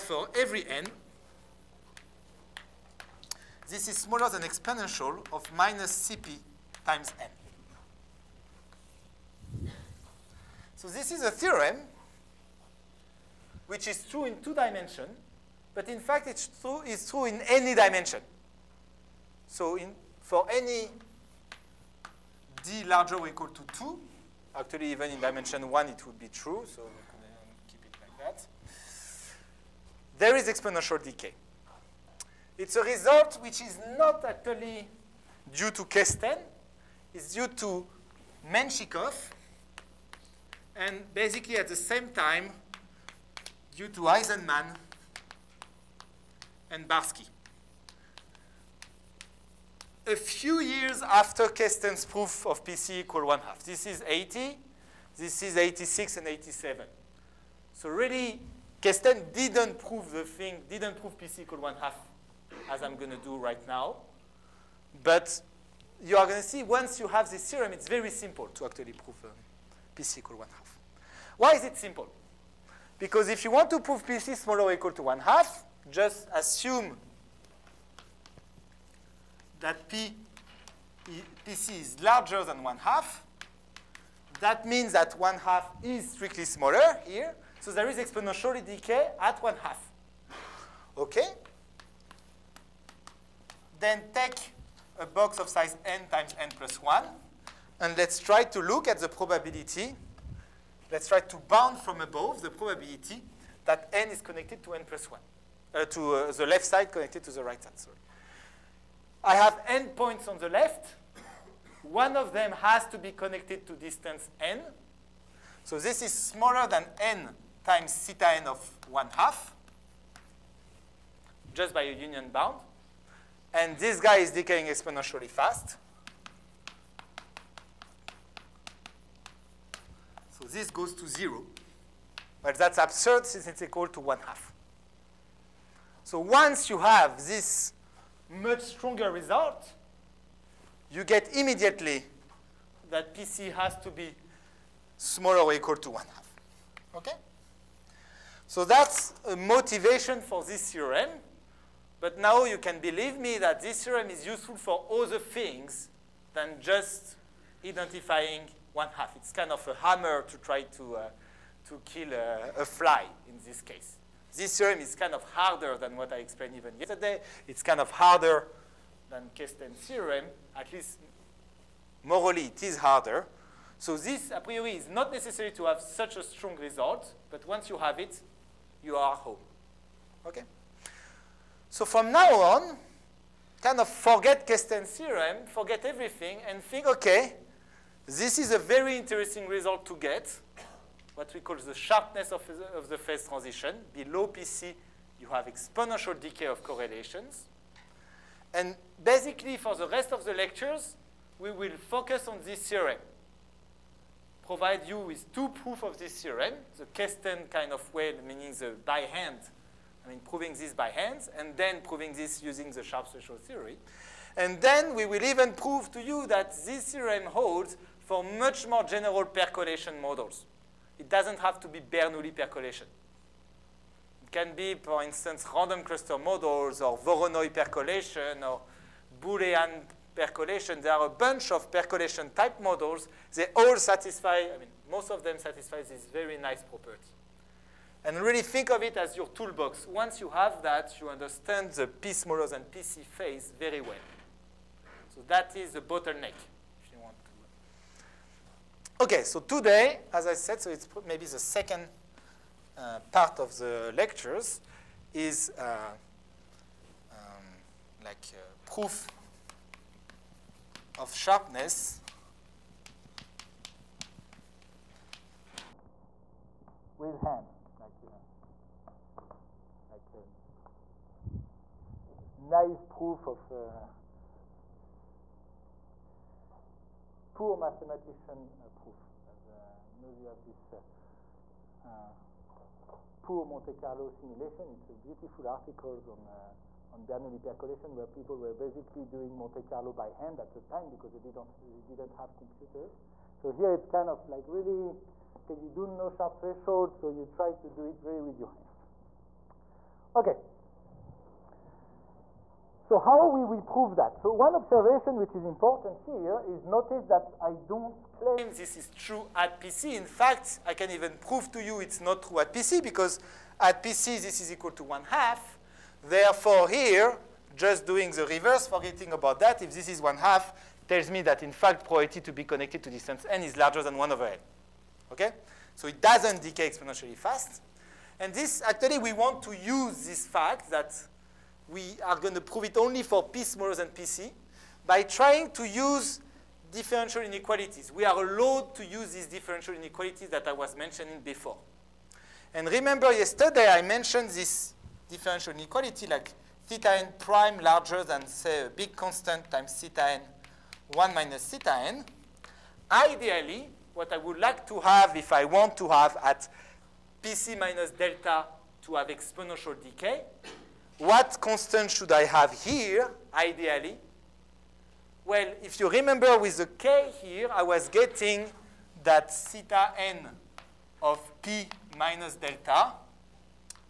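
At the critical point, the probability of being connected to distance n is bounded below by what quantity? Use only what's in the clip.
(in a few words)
1 over n.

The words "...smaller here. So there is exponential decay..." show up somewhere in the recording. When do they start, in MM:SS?
01:26.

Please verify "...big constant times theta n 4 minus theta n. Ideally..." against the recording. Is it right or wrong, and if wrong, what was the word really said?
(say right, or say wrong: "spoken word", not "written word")
wrong: "1", not "4".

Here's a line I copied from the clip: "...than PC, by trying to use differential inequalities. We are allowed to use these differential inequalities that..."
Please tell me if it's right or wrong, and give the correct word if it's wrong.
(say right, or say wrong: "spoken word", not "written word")
right.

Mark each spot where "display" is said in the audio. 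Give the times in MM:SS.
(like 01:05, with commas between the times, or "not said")
not said.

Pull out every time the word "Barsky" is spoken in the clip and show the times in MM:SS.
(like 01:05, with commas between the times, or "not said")
00:46.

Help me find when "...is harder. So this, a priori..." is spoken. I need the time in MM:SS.
02:52.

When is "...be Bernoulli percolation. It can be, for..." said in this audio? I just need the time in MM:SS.
03:41.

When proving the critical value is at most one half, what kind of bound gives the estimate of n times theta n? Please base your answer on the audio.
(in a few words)
union bound.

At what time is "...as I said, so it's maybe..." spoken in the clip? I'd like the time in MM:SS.
04:10.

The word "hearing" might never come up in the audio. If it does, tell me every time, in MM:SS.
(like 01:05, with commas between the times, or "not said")
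not said.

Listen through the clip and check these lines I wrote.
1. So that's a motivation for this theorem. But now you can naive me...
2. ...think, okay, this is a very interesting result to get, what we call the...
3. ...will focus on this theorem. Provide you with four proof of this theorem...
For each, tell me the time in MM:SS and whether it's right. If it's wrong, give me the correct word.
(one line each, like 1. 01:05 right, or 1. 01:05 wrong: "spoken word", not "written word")
1. 02:28 wrong: "believe", not "naive"
2. 03:06 right
3. 03:21 wrong: "two", not "four".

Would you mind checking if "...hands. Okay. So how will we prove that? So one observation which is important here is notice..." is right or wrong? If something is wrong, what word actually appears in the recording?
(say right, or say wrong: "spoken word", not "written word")
right.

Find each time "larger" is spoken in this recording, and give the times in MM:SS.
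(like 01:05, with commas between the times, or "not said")
00:22, 01:22, 05:23, 05:47.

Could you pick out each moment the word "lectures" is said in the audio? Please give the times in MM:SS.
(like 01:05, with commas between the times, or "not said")
03:20, 04:13.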